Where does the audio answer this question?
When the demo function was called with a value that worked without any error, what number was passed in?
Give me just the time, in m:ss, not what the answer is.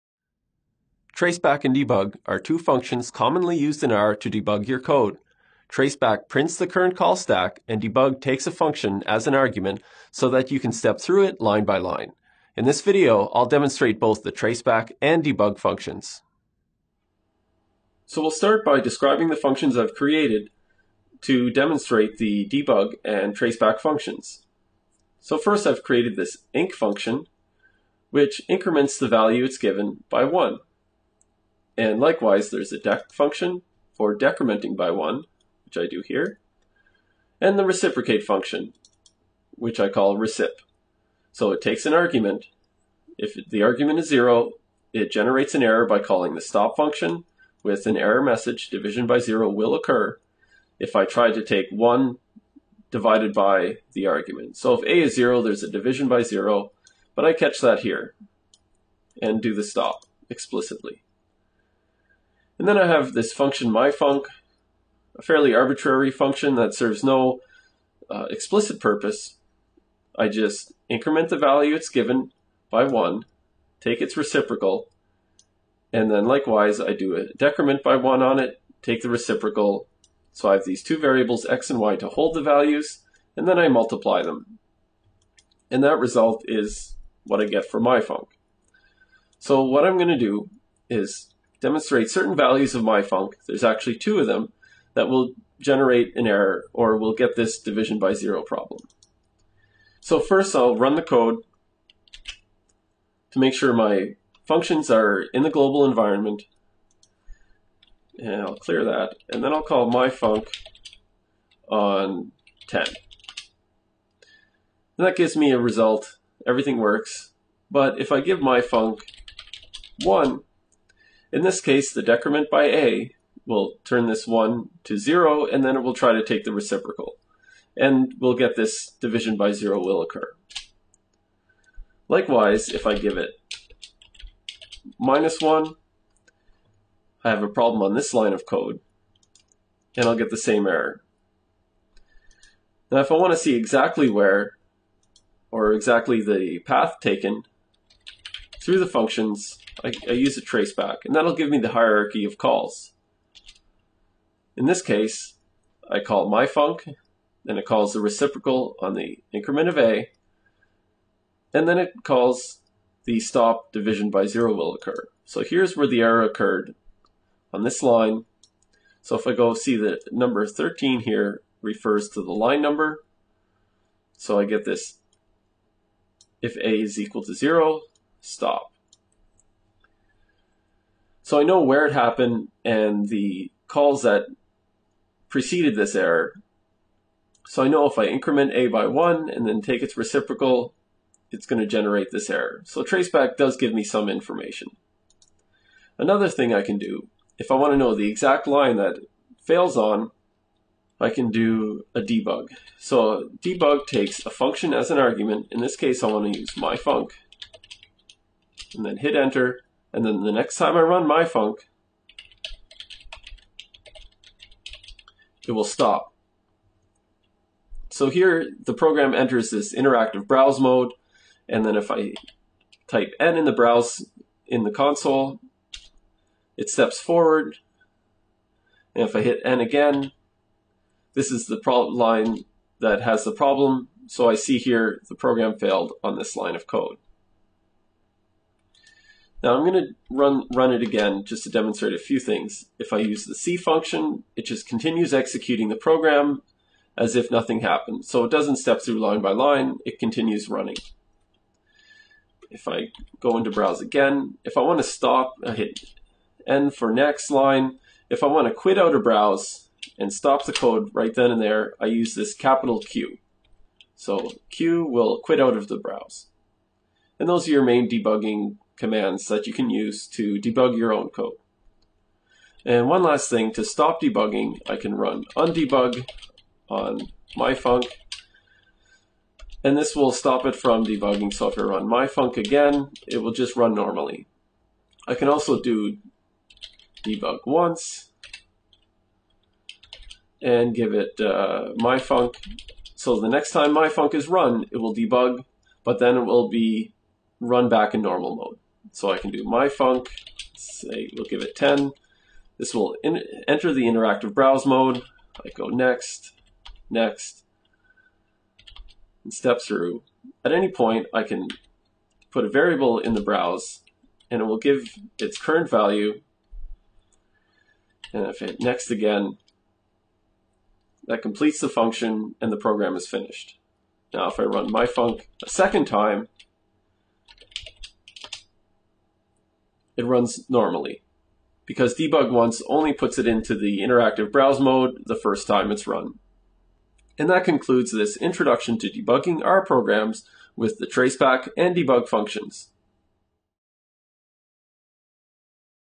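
1:49.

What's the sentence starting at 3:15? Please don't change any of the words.
Another thing I can do, if I want to know the exact line that fails on, I can do a debug.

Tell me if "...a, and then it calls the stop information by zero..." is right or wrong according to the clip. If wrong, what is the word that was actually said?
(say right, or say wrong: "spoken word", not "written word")
wrong: "division", not "information".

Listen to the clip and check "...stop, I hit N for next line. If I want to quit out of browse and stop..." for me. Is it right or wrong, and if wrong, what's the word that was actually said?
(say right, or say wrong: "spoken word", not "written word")
right.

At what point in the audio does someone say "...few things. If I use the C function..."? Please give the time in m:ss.
4:01.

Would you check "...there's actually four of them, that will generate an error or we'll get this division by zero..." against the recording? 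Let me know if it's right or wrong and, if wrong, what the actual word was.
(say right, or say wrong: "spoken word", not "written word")
wrong: "two", not "four".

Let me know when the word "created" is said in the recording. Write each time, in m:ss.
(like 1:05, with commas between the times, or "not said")
0:19, 0:25.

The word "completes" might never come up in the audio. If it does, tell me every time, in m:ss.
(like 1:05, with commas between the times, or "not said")
5:21.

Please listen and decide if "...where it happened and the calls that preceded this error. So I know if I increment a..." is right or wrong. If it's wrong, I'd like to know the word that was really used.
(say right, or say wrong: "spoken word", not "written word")
right.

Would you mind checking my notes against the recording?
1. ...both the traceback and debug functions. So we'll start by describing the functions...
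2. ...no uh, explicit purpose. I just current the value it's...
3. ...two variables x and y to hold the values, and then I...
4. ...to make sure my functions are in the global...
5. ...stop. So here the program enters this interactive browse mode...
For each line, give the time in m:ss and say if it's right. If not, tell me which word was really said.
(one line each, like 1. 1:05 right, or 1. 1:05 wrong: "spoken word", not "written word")
1. 0:13 right
2. 1:07 wrong: "increment", not "current"
3. 1:20 right
4. 1:43 right
5. 3:35 right.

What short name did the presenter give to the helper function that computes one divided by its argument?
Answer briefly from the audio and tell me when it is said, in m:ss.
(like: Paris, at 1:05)
recip, at 0:40.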